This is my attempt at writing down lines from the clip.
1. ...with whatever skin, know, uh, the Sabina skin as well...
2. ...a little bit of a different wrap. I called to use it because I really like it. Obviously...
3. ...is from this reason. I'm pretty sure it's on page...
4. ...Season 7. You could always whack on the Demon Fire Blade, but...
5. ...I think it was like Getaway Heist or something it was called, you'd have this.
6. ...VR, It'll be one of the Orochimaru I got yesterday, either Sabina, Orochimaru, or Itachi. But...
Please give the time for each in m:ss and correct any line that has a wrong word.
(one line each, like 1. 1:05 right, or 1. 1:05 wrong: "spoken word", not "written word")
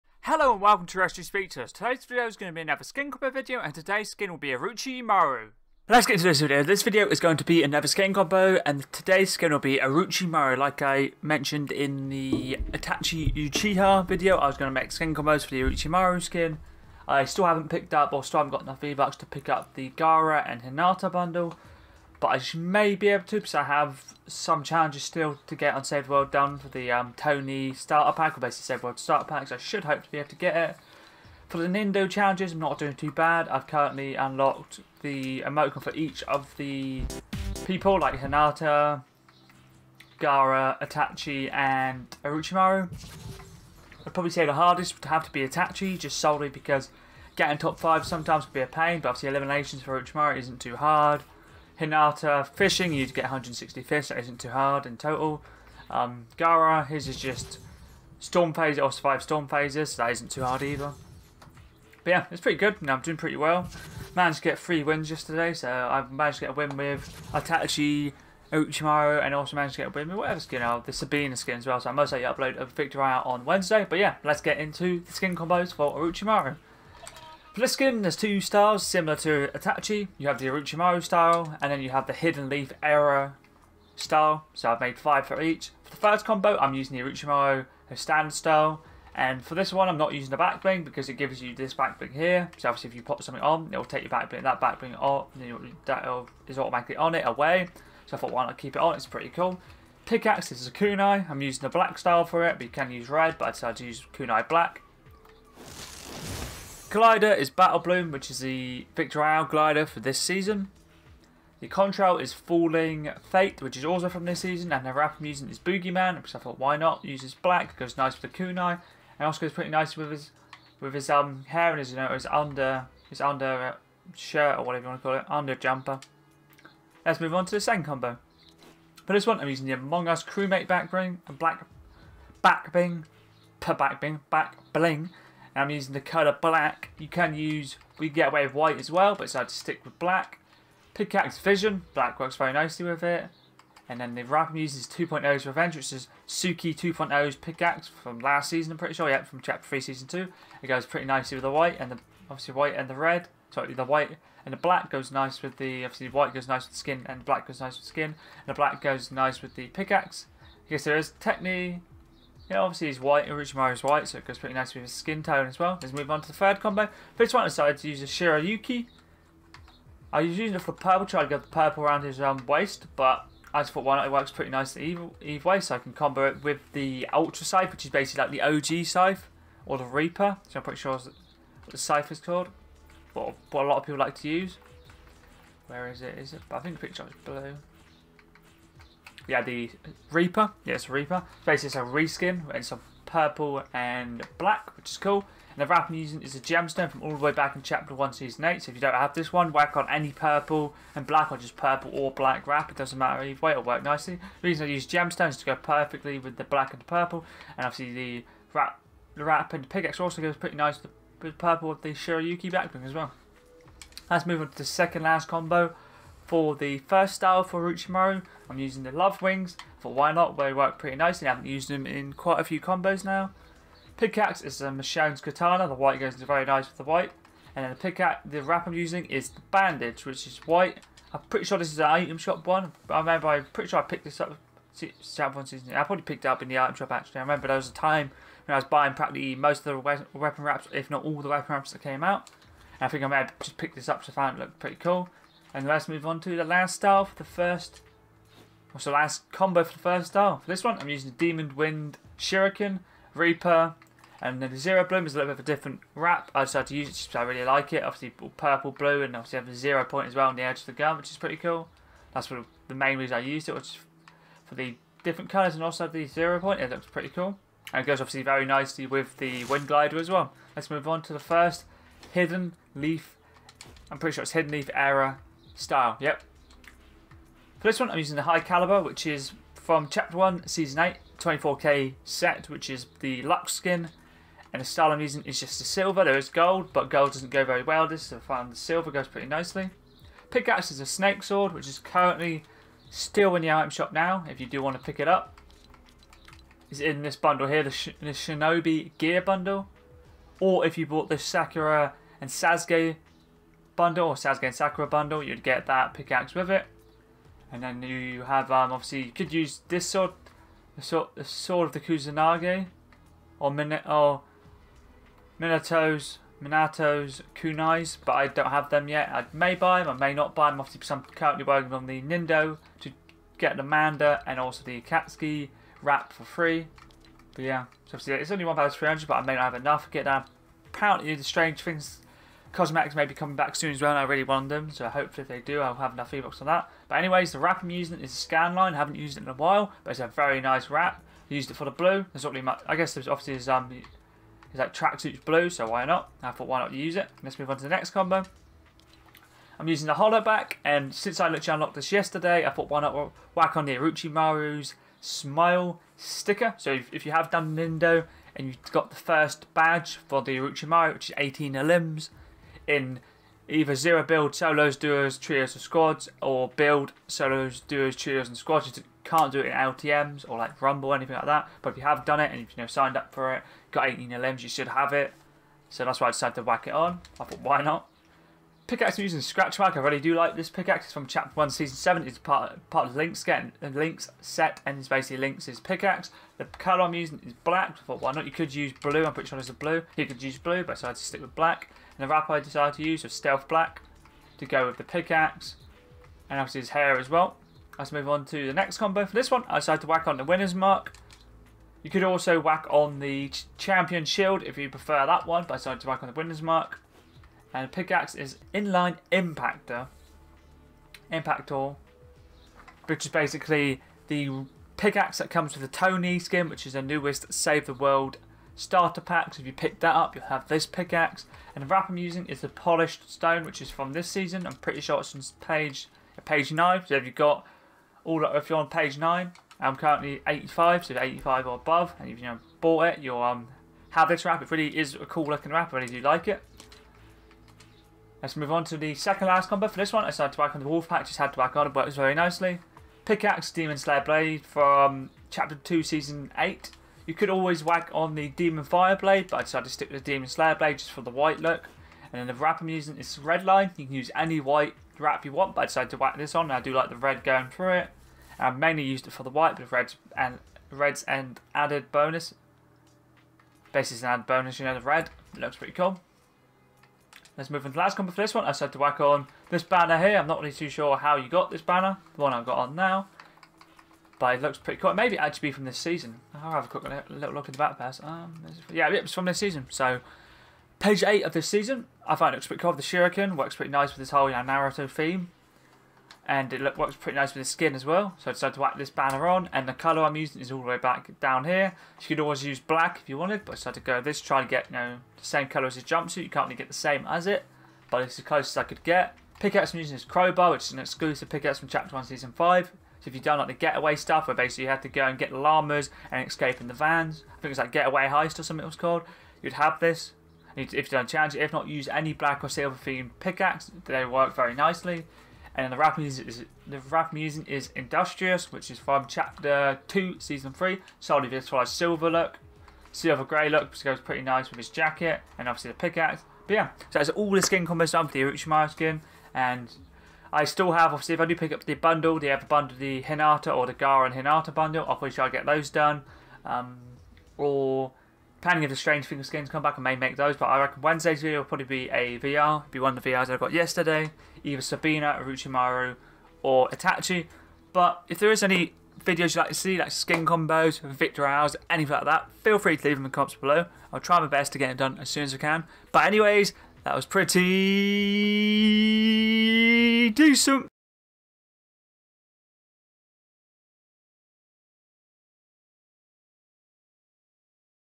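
1. 1:10 right
2. 4:15 wrong: "decided", not "called"
3. 7:03 wrong: "season", not "reason"
4. 7:25 wrong: "8", not "7"
5. 8:27 right
6. 9:02 wrong: "VRs", not "Orochimaru".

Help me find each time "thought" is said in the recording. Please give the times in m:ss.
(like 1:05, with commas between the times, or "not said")
1:38, 1:56, 2:53, 5:46, 5:52, 6:17, 6:27.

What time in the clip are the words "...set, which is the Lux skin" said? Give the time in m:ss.
4:42.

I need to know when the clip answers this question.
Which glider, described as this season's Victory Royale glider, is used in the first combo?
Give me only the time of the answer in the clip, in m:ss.
1:47.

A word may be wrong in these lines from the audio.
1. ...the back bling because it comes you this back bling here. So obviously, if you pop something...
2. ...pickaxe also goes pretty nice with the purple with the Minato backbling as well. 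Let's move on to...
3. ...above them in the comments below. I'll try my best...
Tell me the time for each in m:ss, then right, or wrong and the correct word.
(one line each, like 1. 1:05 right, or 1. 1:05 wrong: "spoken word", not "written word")
1. 1:30 wrong: "gives", not "comes"
2. 3:29 wrong: "Shirayuki", not "Minato"
3. 9:12 wrong: "leave", not "above".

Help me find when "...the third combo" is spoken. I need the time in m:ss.
2:46.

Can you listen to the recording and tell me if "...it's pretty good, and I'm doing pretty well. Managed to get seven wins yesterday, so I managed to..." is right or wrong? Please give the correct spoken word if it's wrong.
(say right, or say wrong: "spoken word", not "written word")
wrong: "three", not "seven".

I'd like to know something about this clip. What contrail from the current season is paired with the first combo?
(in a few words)
Falling Fate.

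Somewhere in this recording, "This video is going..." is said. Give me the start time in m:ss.
0:06.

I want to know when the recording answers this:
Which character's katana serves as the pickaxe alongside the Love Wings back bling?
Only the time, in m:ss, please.
3:44.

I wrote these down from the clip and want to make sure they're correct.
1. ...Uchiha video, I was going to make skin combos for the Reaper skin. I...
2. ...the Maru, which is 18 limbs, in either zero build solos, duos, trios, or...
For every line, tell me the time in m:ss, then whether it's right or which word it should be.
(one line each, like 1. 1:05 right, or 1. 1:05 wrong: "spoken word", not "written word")
1. 0:13 wrong: "Orochimaru", not "Reaper"
2. 6:00 right.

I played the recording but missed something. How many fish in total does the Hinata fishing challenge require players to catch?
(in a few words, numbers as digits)
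160.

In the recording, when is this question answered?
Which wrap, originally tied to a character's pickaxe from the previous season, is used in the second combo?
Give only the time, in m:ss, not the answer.
2:24.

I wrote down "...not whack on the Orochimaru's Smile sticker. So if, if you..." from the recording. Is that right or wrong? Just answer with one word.
right.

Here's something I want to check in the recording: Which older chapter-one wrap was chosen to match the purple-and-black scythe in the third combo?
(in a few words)
Gemstone.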